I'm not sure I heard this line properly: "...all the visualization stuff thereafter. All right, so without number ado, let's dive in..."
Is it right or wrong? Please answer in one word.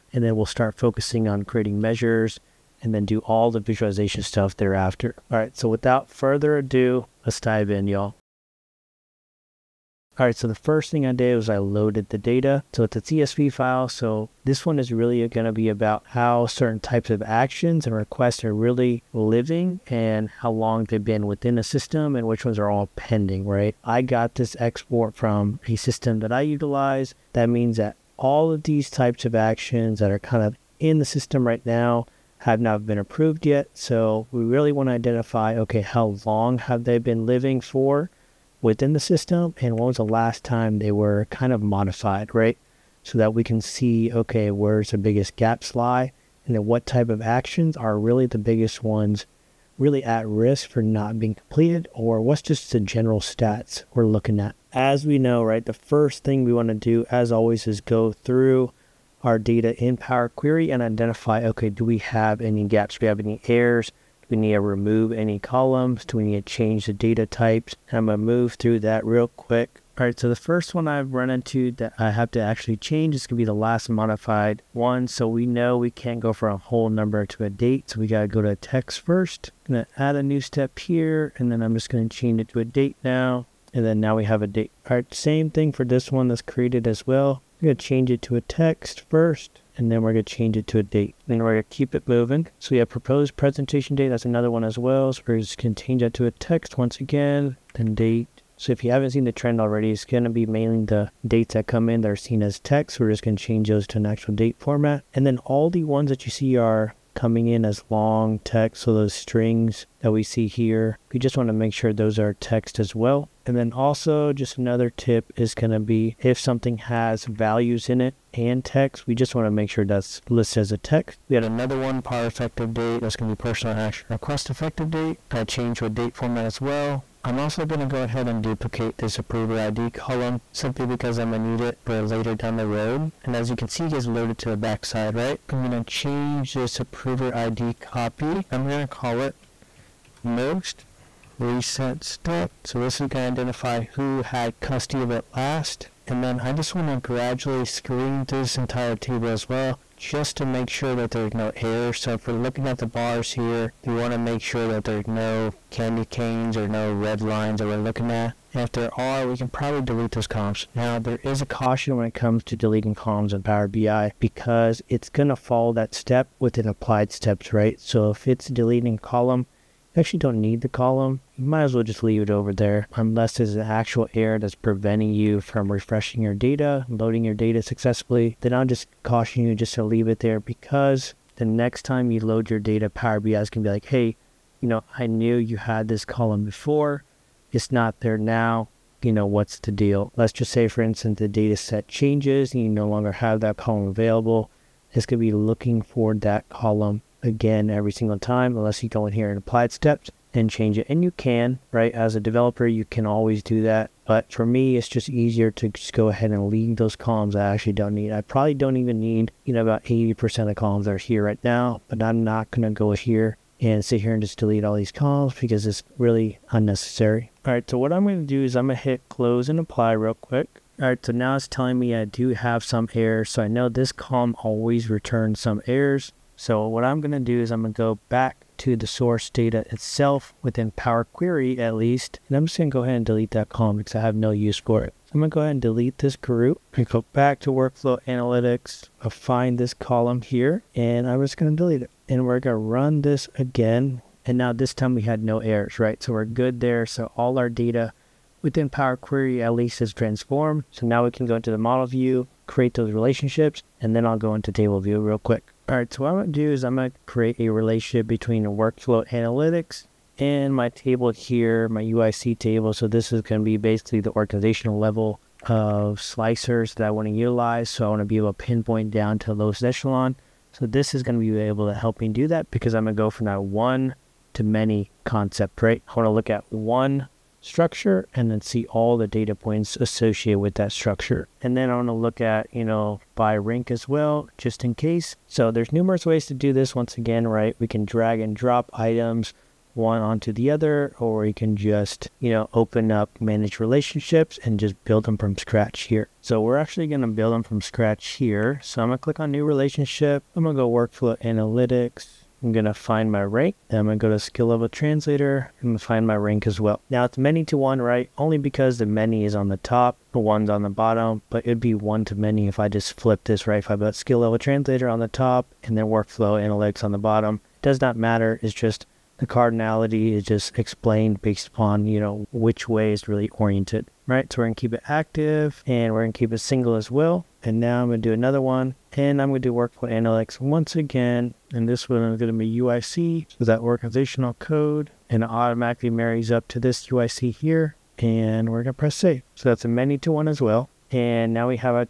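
wrong.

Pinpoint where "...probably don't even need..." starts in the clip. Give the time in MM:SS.
03:28.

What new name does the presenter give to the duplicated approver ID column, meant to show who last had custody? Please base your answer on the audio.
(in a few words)
Most reset step.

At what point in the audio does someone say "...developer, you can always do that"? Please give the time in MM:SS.
03:22.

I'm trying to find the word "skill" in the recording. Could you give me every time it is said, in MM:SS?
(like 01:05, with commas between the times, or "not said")
05:04, 05:13.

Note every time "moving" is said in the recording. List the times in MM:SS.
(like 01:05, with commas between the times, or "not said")
01:32.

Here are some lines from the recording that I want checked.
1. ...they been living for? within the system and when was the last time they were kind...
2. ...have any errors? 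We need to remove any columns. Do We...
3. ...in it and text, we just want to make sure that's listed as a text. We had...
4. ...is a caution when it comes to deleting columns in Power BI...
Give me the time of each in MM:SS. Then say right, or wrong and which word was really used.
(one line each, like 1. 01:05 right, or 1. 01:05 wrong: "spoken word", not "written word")
1. 00:36 right
2. 01:03 right
3. 01:57 right
4. 02:41 right.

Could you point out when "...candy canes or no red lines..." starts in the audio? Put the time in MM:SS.
02:35.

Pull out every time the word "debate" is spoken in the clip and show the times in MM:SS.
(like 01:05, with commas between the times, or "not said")
not said.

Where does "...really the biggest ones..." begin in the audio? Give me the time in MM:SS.
00:47.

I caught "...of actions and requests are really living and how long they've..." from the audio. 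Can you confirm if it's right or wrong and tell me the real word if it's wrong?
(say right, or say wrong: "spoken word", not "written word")
right.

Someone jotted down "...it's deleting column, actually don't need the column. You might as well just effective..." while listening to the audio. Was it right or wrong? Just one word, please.
wrong.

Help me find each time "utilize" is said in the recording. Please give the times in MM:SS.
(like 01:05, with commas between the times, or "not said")
00:26, 04:27.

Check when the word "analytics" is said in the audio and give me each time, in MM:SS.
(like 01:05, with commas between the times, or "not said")
03:58, 04:19, 05:01, 05:16, 05:29.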